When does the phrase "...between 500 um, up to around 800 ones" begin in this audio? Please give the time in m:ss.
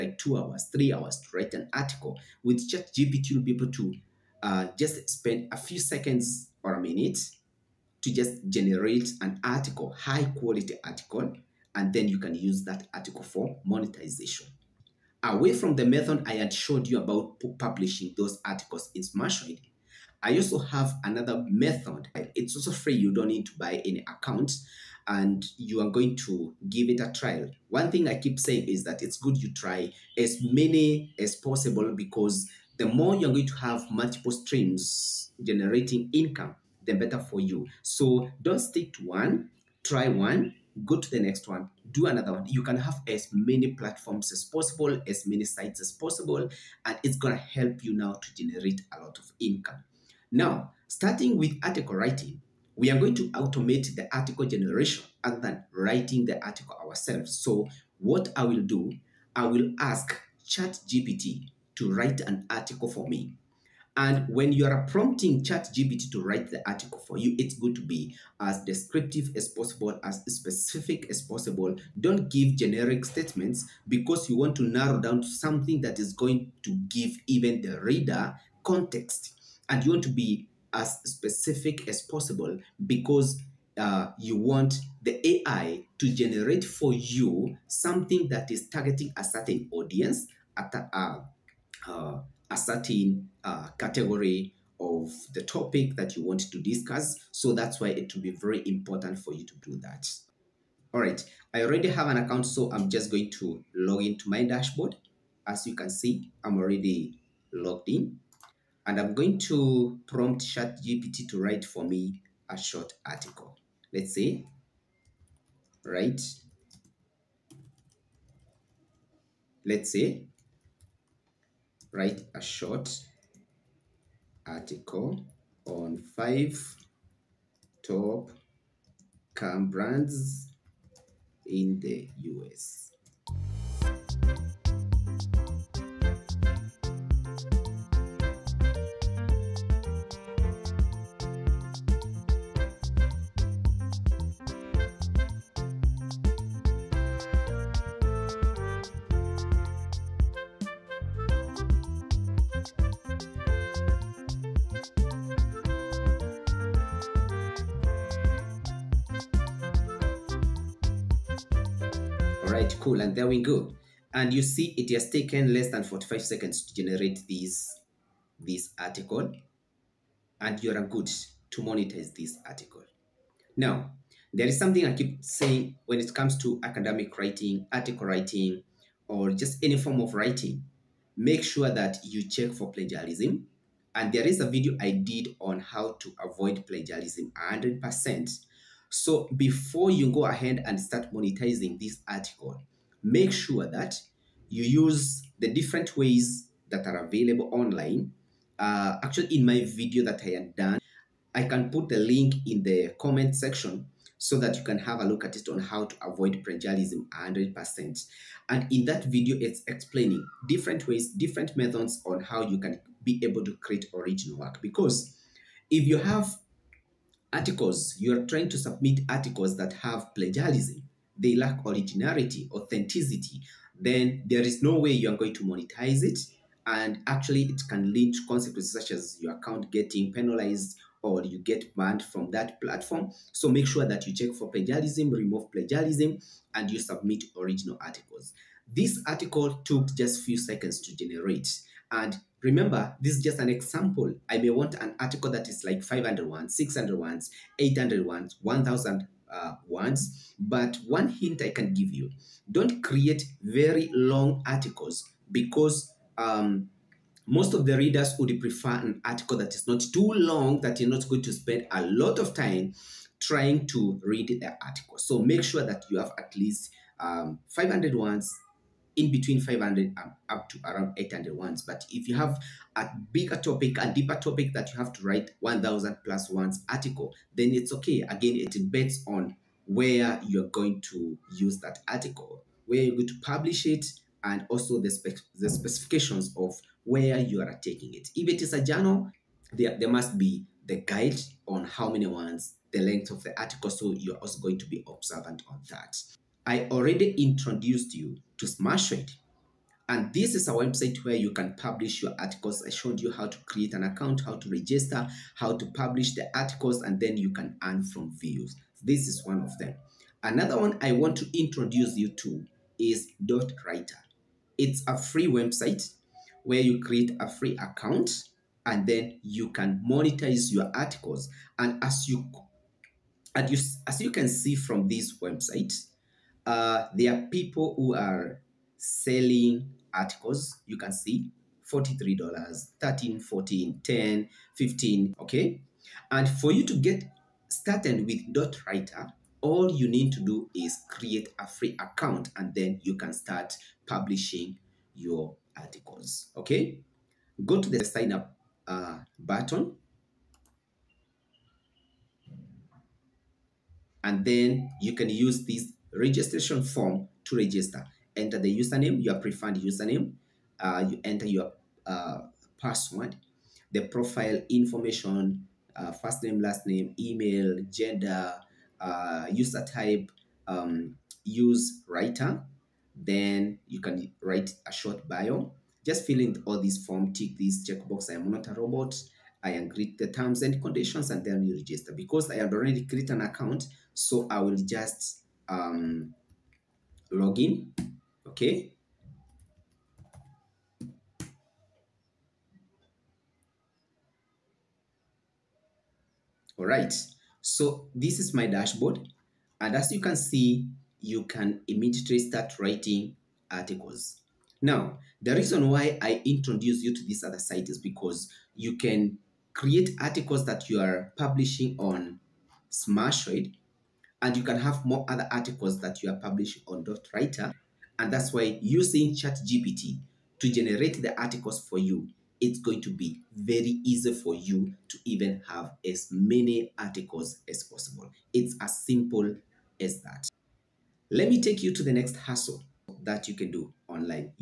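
4:29.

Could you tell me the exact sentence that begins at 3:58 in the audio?
This article took just few seconds to generate.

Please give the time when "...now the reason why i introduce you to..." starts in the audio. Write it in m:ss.
6:44.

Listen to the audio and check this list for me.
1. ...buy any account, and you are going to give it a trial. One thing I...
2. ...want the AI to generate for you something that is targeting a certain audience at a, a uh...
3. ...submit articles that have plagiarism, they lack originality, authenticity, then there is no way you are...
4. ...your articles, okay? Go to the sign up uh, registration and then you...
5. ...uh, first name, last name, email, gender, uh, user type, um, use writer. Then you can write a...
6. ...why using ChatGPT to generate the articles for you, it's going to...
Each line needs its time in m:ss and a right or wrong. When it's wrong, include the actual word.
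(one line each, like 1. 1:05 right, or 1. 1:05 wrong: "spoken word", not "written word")
1. 0:23 right
2. 1:24 right
3. 3:38 right
4. 5:44 wrong: "button", not "registration"
5. 6:05 right
6. 6:58 right.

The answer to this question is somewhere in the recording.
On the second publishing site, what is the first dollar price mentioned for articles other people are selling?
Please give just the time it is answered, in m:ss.
5:31.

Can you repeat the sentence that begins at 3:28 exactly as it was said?
And in that video, it's explaining different ways, different methods on how you can be able to create original work.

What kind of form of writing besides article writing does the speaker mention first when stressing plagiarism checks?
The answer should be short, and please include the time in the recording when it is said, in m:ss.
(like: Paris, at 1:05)
Academic writing, at 2:56.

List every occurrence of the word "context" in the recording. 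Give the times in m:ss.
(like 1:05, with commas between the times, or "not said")
1:18.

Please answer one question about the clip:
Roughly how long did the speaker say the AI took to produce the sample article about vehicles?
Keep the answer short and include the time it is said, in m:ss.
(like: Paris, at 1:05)
Less than 45 seconds, at 2:45.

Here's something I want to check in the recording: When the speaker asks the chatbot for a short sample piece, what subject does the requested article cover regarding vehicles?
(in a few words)
Five top car brands in the US.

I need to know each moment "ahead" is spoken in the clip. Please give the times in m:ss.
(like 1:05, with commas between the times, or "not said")
3:10.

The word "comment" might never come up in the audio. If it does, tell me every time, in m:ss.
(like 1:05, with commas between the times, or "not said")
3:22.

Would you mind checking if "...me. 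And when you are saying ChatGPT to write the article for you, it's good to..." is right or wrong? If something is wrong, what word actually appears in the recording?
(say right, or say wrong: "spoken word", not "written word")
wrong: "prompting", not "saying".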